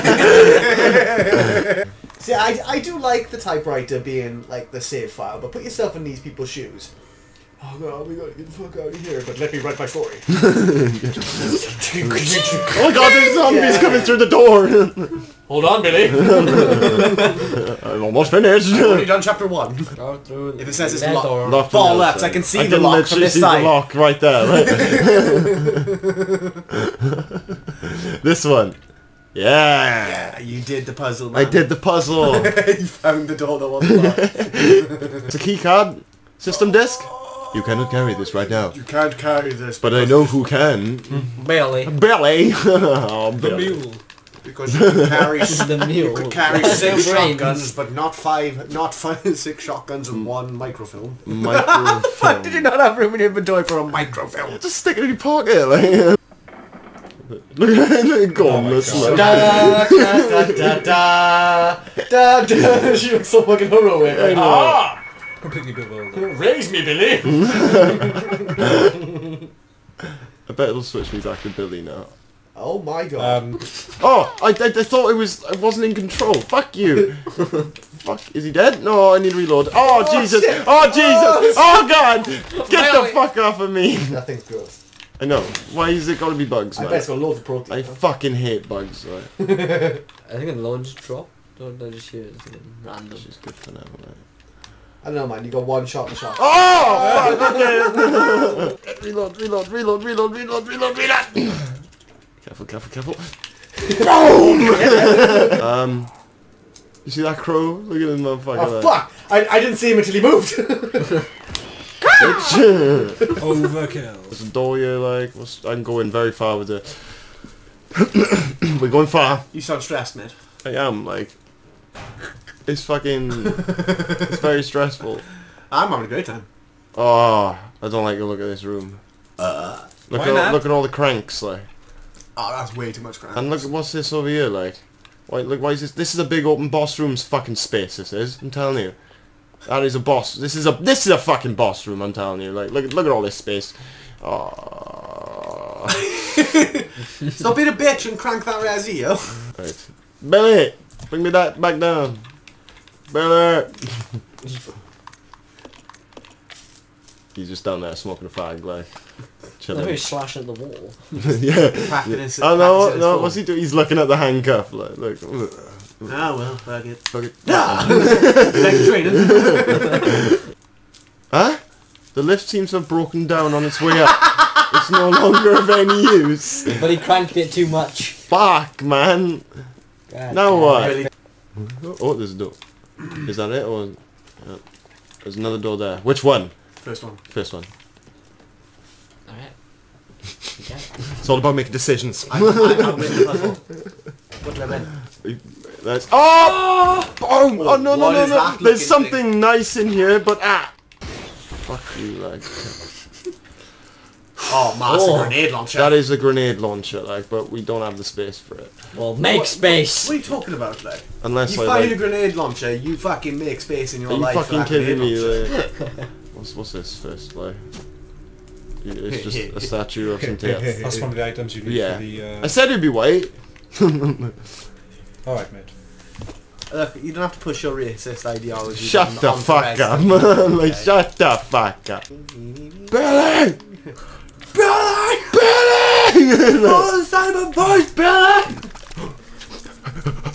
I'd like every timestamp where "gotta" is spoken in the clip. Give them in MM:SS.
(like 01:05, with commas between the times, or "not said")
00:08, 01:26.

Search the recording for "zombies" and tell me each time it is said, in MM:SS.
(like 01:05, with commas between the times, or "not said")
00:13.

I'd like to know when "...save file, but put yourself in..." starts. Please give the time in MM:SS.
00:04.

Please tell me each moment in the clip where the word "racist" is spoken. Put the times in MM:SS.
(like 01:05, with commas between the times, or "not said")
03:47.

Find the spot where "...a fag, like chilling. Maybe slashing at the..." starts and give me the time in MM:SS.
02:38.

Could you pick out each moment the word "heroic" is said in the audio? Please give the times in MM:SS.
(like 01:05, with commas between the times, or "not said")
01:03.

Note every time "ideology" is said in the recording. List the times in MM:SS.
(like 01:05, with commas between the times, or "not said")
03:48.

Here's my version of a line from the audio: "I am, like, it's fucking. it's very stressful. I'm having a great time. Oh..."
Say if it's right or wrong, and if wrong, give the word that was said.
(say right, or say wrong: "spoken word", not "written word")
right.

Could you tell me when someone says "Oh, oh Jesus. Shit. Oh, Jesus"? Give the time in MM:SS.
01:19.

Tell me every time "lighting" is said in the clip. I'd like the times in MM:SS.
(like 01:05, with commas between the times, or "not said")
not said.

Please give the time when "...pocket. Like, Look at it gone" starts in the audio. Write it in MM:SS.
00:55.